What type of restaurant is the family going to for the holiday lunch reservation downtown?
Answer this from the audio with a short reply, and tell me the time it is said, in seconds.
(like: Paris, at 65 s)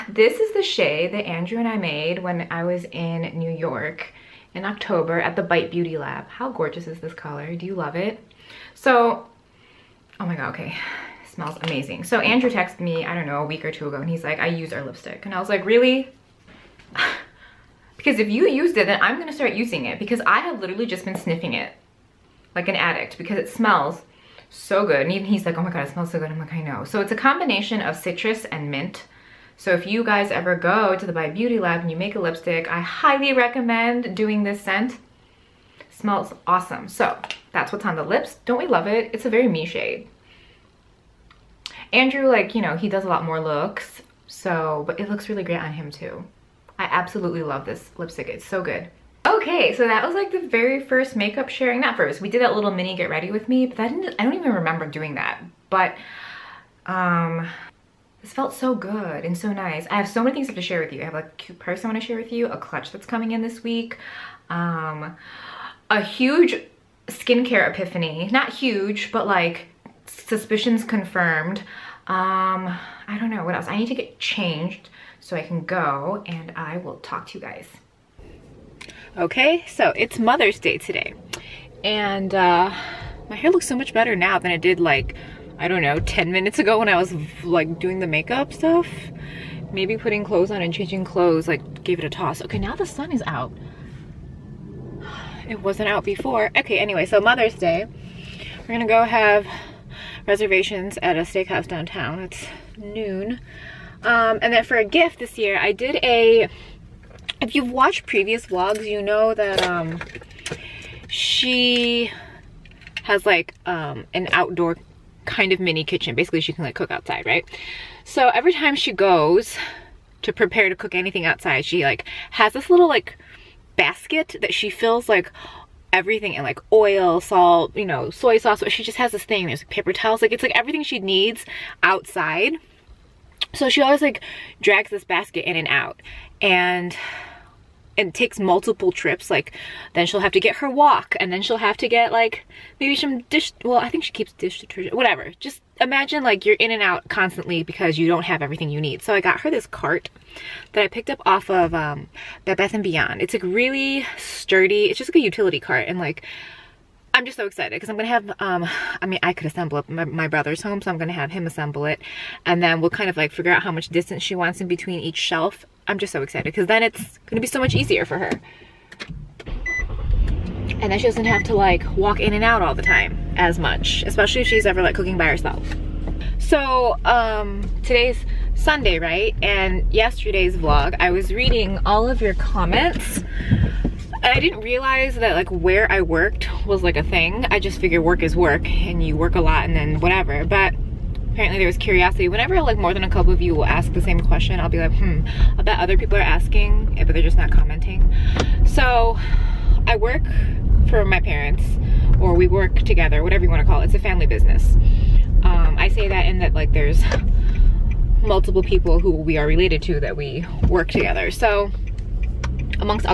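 Steakhouse, at 101 s.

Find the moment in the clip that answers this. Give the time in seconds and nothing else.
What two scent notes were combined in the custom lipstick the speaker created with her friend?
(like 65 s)
27 s.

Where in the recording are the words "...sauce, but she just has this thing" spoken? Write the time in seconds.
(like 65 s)
128 s.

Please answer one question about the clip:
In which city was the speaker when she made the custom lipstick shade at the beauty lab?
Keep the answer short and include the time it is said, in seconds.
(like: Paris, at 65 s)
New York, at 3 s.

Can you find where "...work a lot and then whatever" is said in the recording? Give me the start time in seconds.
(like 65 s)
189 s.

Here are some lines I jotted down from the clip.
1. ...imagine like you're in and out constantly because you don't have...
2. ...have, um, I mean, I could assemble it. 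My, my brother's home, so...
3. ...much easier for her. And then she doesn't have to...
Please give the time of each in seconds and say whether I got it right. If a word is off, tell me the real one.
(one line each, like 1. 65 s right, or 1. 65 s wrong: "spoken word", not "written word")
1. 145 s right
2. 158 s right
3. 167 s right.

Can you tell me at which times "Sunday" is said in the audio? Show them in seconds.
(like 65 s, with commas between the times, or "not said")
178 s.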